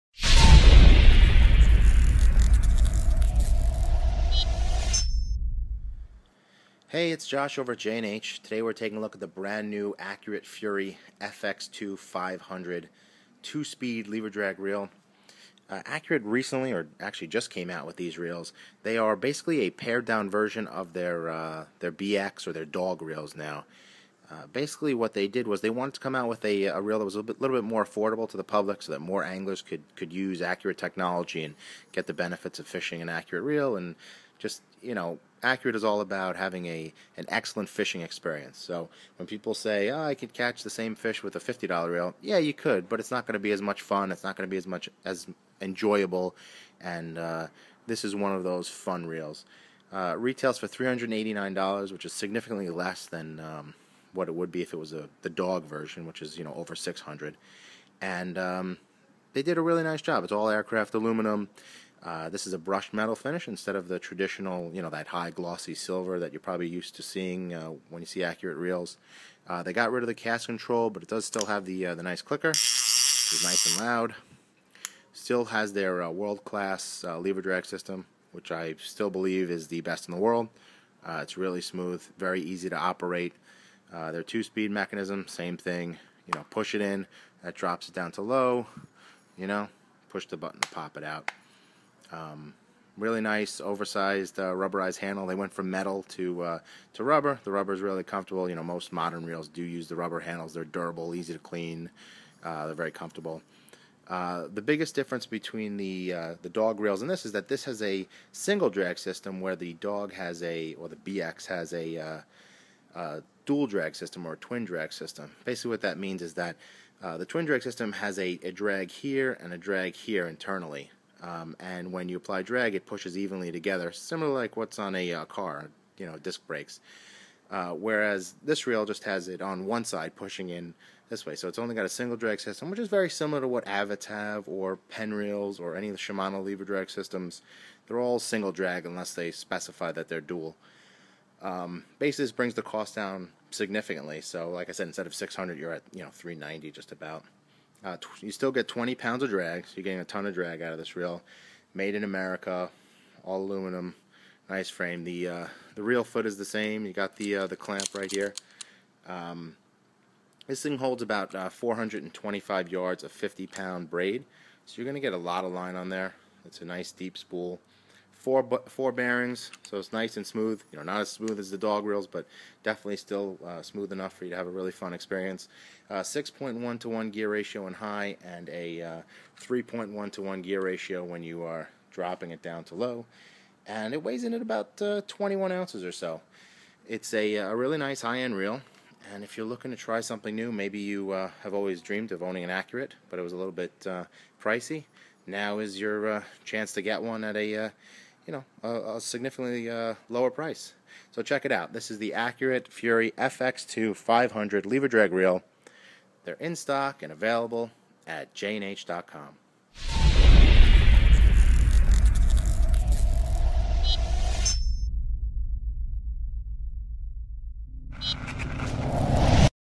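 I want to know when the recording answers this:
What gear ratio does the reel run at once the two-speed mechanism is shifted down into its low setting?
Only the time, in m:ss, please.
2:59.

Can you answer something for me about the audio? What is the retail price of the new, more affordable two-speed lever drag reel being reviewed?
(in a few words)
$389.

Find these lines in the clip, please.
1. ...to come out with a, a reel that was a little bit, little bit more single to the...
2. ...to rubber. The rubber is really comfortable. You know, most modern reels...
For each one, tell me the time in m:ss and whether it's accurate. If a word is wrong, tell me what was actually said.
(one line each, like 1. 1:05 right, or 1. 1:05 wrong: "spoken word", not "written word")
1. 0:25 wrong: "affordable", not "single"
2. 1:36 right.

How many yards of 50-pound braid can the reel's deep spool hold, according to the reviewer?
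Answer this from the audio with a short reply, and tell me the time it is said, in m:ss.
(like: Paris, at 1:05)
425, at 2:41.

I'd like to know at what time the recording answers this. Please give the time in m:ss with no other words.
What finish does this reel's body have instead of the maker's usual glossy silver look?
1:02.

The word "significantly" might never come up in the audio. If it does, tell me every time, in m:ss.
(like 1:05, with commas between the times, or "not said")
0:52, 2:23, 3:19.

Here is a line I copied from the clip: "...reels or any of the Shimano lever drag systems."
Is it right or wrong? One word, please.
right.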